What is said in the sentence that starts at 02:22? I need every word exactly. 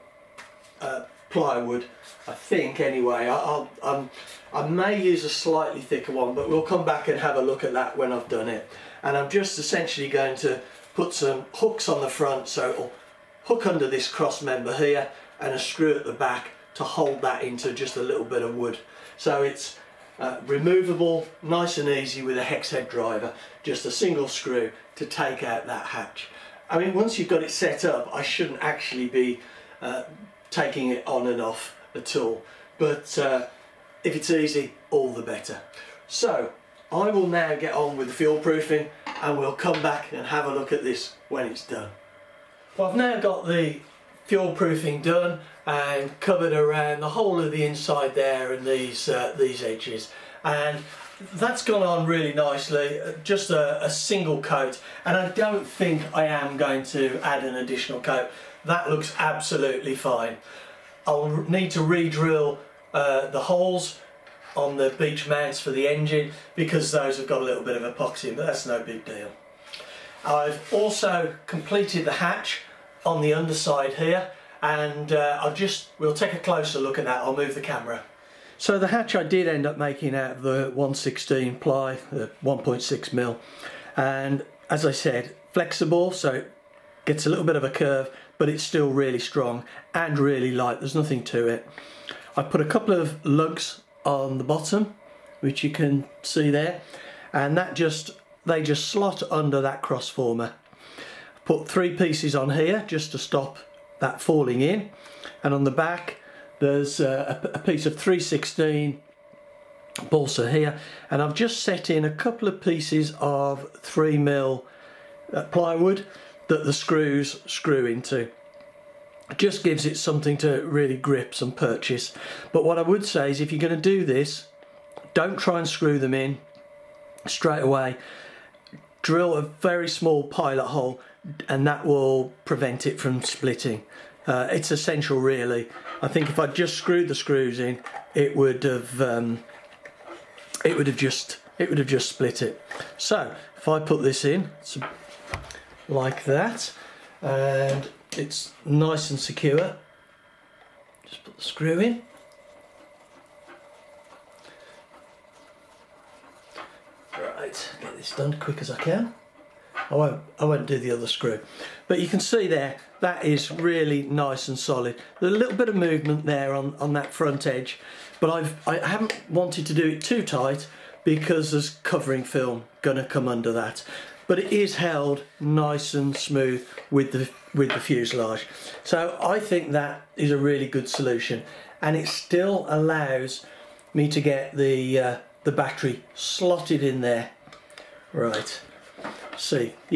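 So if I put this in like that, and it's nice and secure.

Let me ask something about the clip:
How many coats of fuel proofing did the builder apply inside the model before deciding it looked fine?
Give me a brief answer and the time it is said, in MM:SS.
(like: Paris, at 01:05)
1, at 00:53.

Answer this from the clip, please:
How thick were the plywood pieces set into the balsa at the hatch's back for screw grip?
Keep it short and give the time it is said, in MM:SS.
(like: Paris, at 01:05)
3 mil, at 01:53.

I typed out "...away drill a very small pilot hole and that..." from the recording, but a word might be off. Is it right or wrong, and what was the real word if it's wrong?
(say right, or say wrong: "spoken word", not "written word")
right.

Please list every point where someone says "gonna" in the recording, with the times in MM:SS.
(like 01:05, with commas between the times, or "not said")
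02:52.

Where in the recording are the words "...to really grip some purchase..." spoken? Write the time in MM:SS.
02:00.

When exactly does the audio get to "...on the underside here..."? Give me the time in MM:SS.
01:13.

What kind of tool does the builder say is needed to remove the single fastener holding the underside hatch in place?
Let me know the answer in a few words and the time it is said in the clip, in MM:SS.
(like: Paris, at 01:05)
hex head driver, at 00:22.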